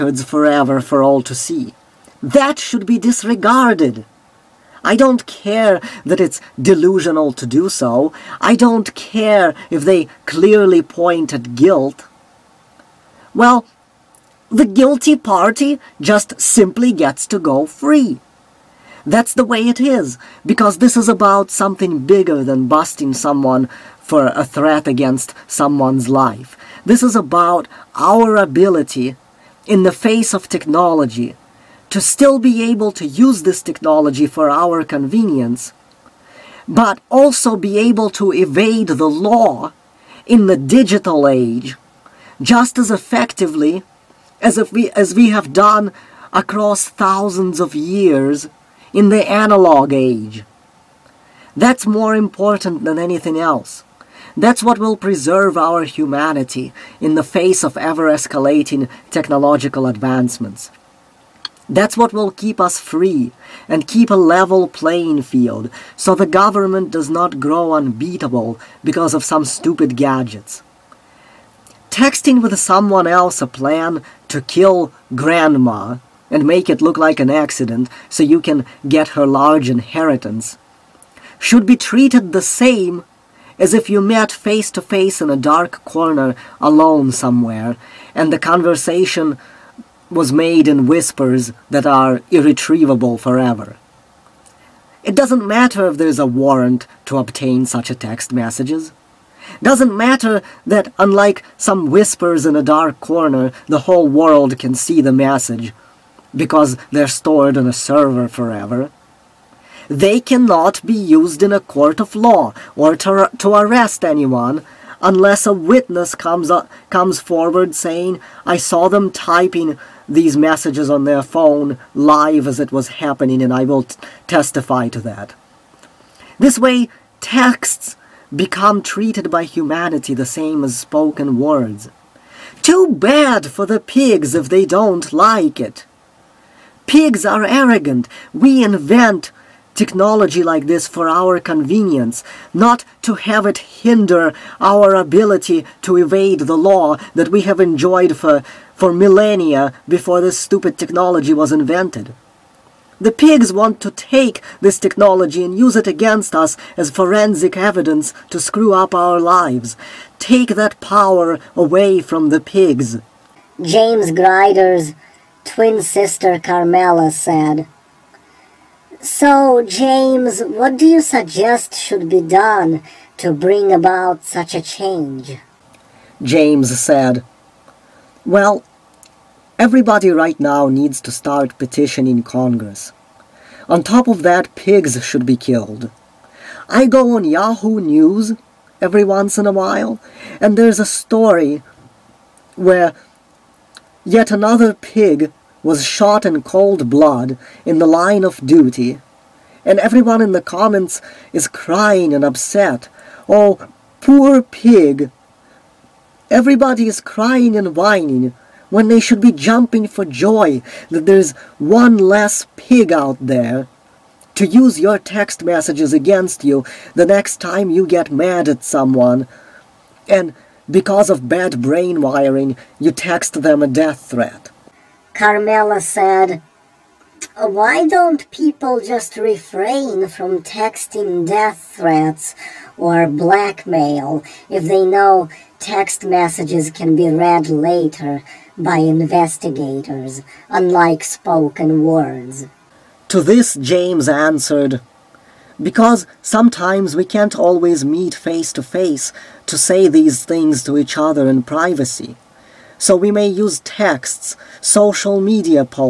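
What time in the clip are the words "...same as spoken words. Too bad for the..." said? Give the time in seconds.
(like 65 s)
130 s.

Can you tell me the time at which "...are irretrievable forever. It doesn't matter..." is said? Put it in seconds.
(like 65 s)
91 s.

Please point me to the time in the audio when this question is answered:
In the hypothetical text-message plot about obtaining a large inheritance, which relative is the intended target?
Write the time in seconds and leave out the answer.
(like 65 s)
75 s.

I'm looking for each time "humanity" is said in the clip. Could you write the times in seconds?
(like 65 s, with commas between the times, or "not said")
55 s, 129 s.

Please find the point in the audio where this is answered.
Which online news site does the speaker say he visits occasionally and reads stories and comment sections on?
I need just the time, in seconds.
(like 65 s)
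187 s.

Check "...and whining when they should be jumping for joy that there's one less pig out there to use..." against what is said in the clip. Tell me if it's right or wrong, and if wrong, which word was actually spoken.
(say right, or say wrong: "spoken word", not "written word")
right.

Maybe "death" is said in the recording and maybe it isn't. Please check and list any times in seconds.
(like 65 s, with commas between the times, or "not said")
223 s, 231 s.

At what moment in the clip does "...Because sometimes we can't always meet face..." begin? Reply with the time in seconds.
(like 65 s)
245 s.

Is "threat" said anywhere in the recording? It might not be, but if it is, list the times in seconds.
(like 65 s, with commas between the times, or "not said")
24 s, 224 s, 231 s.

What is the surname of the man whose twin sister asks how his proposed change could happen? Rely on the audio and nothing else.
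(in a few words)
Grider.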